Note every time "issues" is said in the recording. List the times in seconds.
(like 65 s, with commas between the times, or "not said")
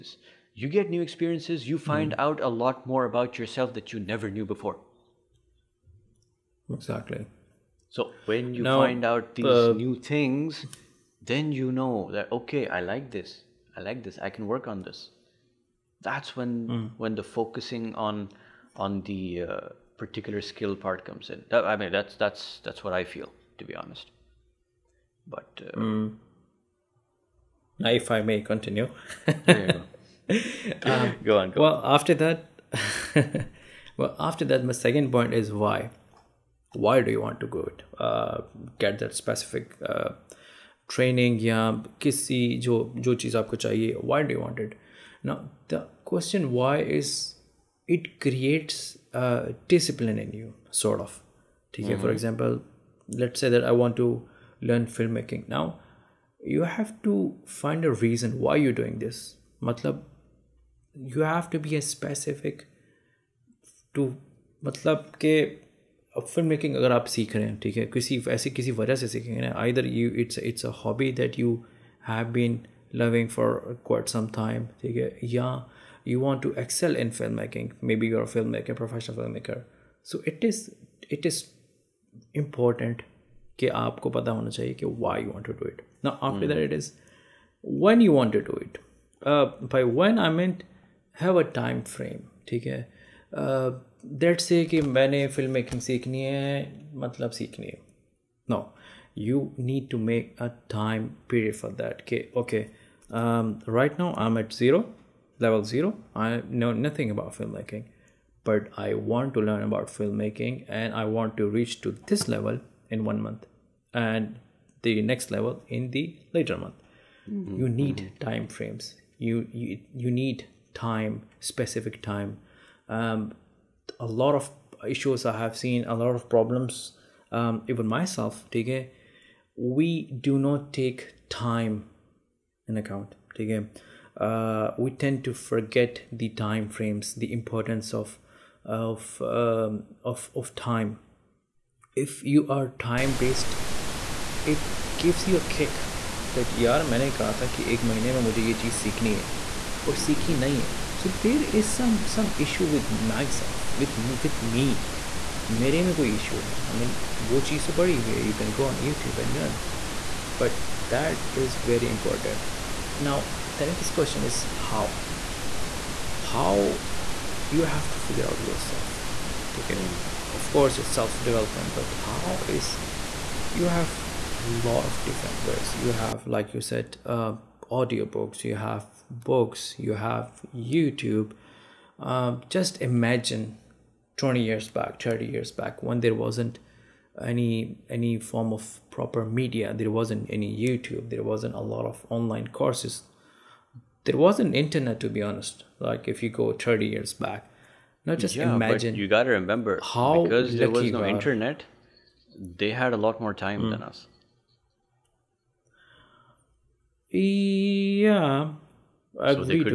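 124 s, 152 s.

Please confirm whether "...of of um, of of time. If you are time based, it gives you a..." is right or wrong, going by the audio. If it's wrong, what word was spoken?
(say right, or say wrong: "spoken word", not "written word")
right.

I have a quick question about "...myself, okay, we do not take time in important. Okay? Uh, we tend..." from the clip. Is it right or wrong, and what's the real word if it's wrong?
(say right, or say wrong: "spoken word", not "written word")
wrong: "account", not "important".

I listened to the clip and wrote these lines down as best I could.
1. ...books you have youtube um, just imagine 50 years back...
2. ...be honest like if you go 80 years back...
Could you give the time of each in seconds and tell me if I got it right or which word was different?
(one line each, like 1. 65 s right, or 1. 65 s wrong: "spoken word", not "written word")
1. 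179 s wrong: "20", not "50"
2. 195 s wrong: "30", not "80".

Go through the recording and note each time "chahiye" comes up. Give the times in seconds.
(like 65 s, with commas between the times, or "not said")
43 s.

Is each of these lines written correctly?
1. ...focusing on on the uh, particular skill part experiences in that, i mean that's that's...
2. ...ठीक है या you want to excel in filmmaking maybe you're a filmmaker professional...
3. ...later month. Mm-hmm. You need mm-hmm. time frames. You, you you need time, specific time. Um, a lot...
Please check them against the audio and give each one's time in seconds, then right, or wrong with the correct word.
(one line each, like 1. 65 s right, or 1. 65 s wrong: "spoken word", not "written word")
1. 17 s wrong: "comes", not "experiences"
2. 74 s right
3. 116 s right.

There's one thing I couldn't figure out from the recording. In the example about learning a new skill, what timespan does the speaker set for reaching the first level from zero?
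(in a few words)
one month.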